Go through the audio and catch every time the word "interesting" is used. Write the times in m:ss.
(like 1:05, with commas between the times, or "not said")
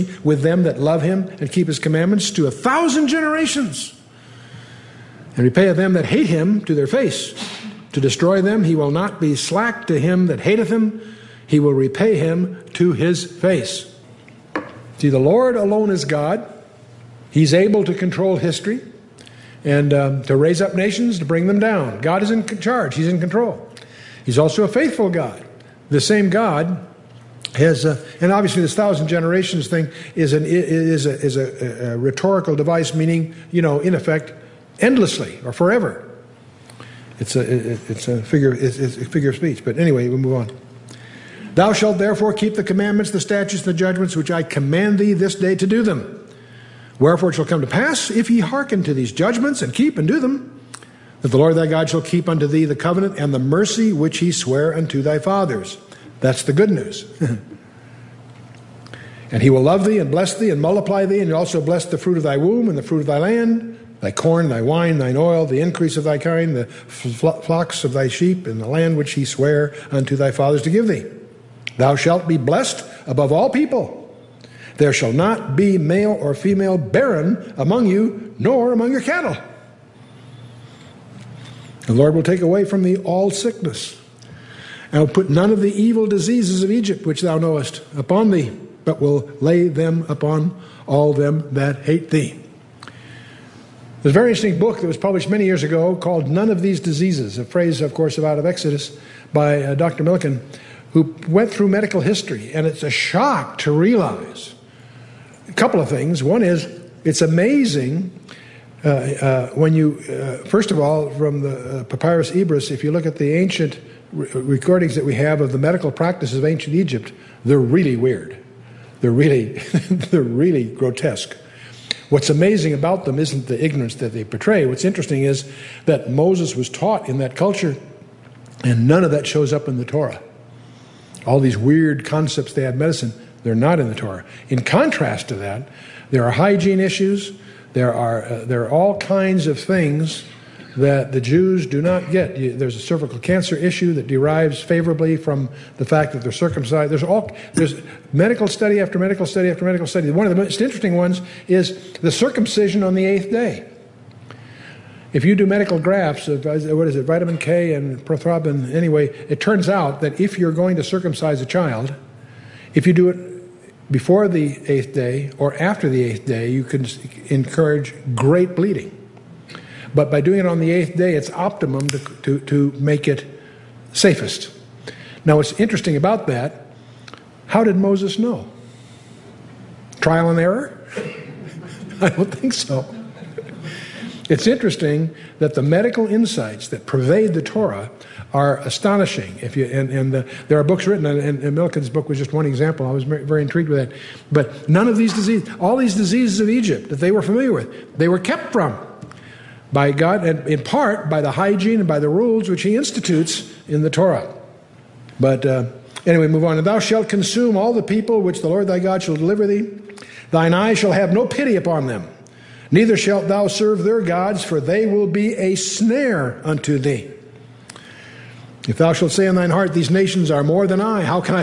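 1:34, 2:04, 2:30, 2:55, 3:04.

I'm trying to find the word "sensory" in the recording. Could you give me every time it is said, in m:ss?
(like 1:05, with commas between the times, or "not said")
not said.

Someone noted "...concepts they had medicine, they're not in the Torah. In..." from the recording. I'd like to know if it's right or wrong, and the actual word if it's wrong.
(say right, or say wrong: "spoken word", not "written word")
right.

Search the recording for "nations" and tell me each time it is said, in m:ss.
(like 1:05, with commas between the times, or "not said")
0:20, 3:39.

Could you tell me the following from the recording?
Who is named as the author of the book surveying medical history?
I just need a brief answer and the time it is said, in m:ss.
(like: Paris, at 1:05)
Dr. Milliken, at 1:39.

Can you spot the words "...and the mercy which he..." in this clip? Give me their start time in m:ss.
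0:53.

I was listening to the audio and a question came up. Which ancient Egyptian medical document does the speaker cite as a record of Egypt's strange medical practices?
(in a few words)
Papyrus Ebers.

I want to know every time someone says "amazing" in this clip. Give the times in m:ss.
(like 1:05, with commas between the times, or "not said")
1:47, 2:02.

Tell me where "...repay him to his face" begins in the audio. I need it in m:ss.
0:11.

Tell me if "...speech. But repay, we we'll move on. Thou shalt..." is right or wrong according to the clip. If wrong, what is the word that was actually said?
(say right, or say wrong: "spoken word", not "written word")
wrong: "anyway", not "repay".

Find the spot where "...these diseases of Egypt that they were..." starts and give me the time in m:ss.
3:15.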